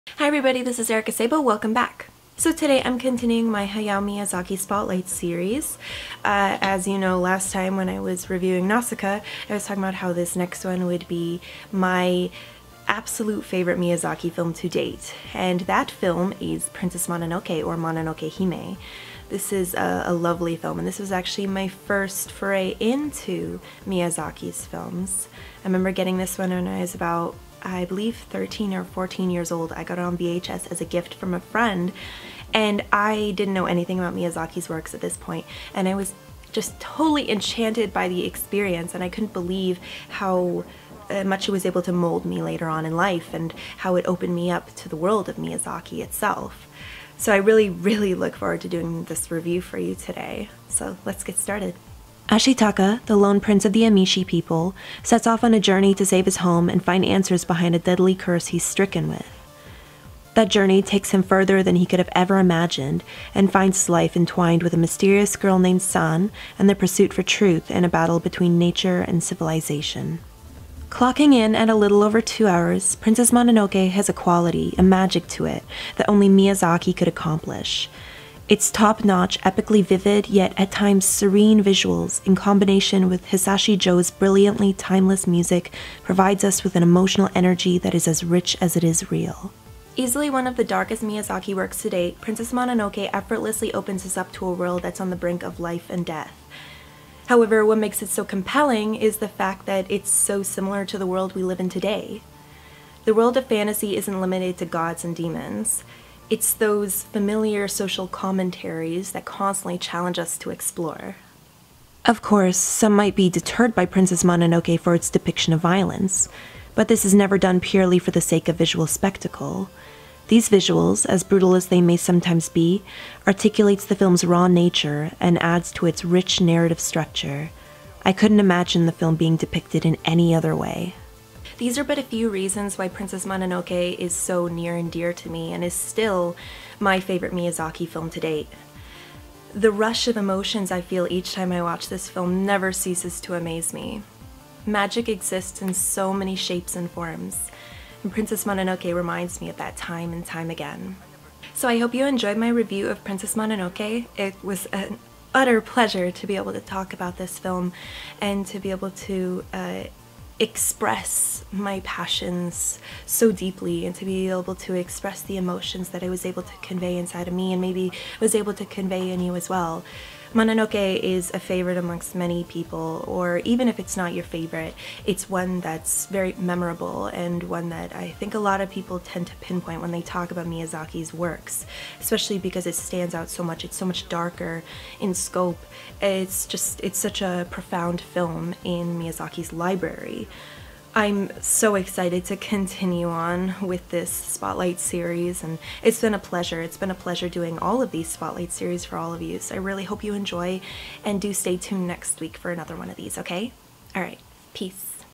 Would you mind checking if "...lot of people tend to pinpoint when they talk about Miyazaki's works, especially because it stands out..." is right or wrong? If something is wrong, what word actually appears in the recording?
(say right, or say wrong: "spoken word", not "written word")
right.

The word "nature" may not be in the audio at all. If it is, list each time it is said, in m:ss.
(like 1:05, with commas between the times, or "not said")
1:08, 2:04.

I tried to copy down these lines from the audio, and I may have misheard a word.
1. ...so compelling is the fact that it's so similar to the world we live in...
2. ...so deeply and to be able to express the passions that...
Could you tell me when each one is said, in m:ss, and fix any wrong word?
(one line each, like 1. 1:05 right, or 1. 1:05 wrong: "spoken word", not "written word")
1. 1:38 right
2. 2:43 wrong: "emotions", not "passions".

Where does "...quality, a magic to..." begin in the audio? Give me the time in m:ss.
1:14.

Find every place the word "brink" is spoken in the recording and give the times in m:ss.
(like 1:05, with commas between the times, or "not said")
1:35.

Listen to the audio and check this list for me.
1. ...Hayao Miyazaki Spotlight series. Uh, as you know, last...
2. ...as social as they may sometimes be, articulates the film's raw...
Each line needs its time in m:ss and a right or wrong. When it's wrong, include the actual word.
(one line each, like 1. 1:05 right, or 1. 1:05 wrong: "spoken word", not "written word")
1. 0:03 right
2. 2:01 wrong: "brutal", not "social".